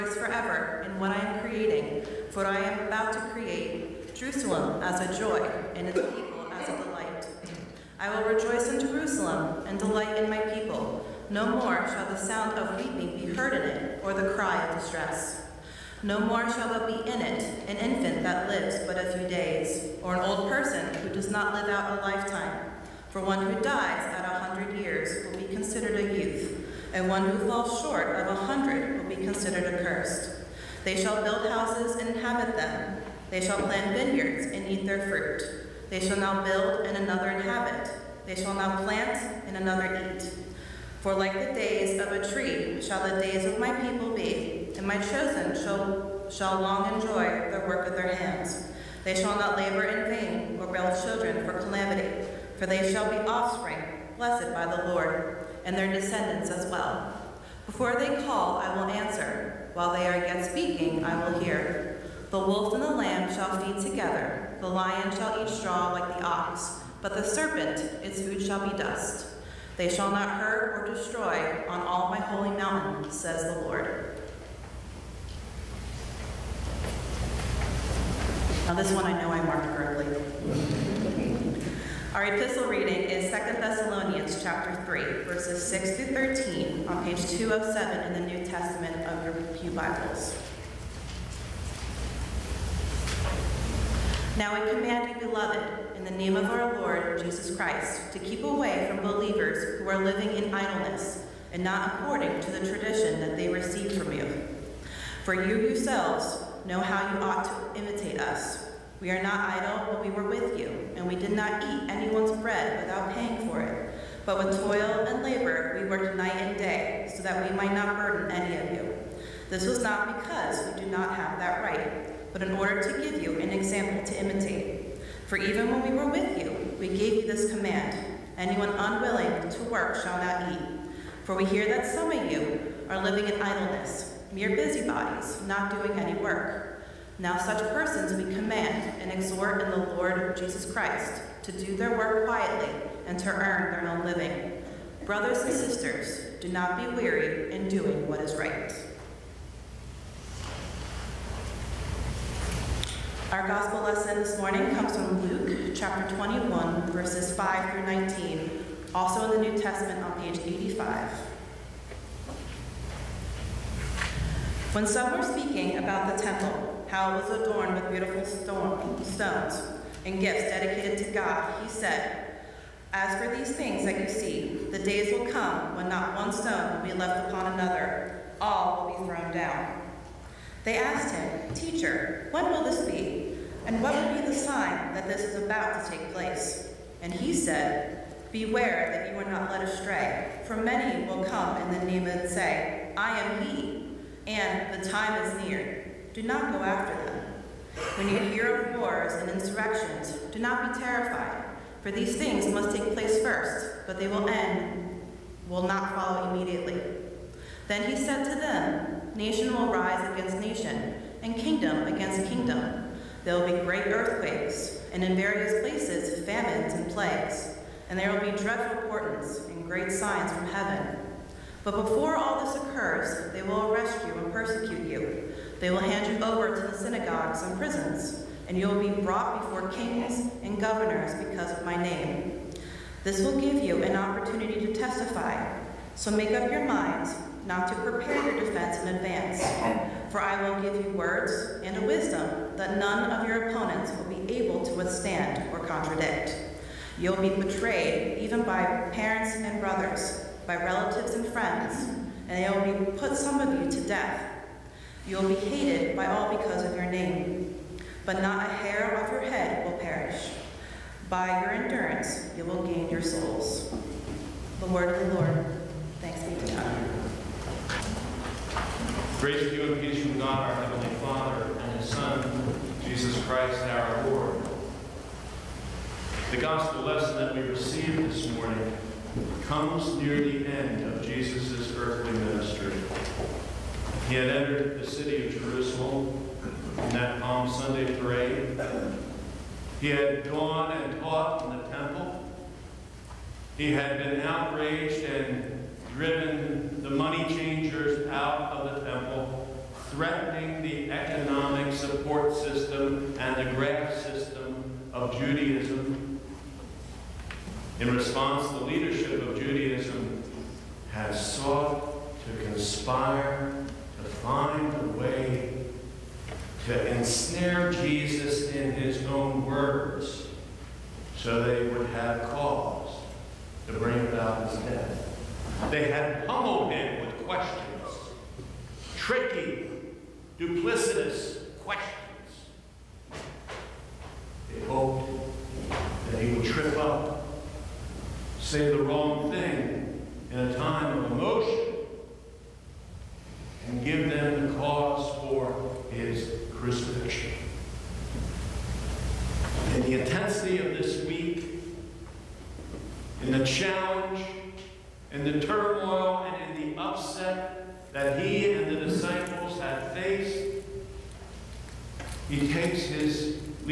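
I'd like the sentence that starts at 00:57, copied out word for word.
Before they call, I will answer.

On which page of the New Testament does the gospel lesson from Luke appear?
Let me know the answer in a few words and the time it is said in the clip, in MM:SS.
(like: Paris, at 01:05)
85, at 02:40.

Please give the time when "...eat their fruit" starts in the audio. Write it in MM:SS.
00:34.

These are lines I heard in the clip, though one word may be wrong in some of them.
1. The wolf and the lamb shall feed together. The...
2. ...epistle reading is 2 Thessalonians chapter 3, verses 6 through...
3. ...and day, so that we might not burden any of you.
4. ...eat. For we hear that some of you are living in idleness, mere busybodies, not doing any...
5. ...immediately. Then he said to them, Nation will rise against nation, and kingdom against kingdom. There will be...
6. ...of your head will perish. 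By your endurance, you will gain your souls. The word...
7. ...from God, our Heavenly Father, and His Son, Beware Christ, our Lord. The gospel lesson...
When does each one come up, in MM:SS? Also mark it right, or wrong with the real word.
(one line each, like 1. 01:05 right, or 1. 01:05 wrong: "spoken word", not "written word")
1. 01:02 right
2. 01:22 right
3. 01:56 right
4. 02:10 right
5. 03:26 right
6. 04:19 right
7. 04:30 wrong: "Jesus", not "Beware".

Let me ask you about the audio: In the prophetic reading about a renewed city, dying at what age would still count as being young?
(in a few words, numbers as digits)
100.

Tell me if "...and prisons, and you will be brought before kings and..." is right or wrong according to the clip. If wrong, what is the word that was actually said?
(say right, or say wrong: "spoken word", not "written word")
right.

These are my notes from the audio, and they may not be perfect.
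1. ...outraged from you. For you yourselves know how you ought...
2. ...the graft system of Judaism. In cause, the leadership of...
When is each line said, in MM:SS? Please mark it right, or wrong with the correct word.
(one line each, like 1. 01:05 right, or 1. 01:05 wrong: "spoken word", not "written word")
1. 01:43 wrong: "received", not "outraged"
2. 05:03 wrong: "response", not "cause".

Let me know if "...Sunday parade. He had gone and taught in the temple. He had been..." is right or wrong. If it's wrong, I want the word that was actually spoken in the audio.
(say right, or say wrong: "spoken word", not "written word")
right.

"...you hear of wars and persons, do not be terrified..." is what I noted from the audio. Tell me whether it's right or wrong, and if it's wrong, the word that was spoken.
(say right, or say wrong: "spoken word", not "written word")
wrong: "insurrections", not "persons".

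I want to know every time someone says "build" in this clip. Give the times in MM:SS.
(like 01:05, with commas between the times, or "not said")
00:31, 00:36, 00:50.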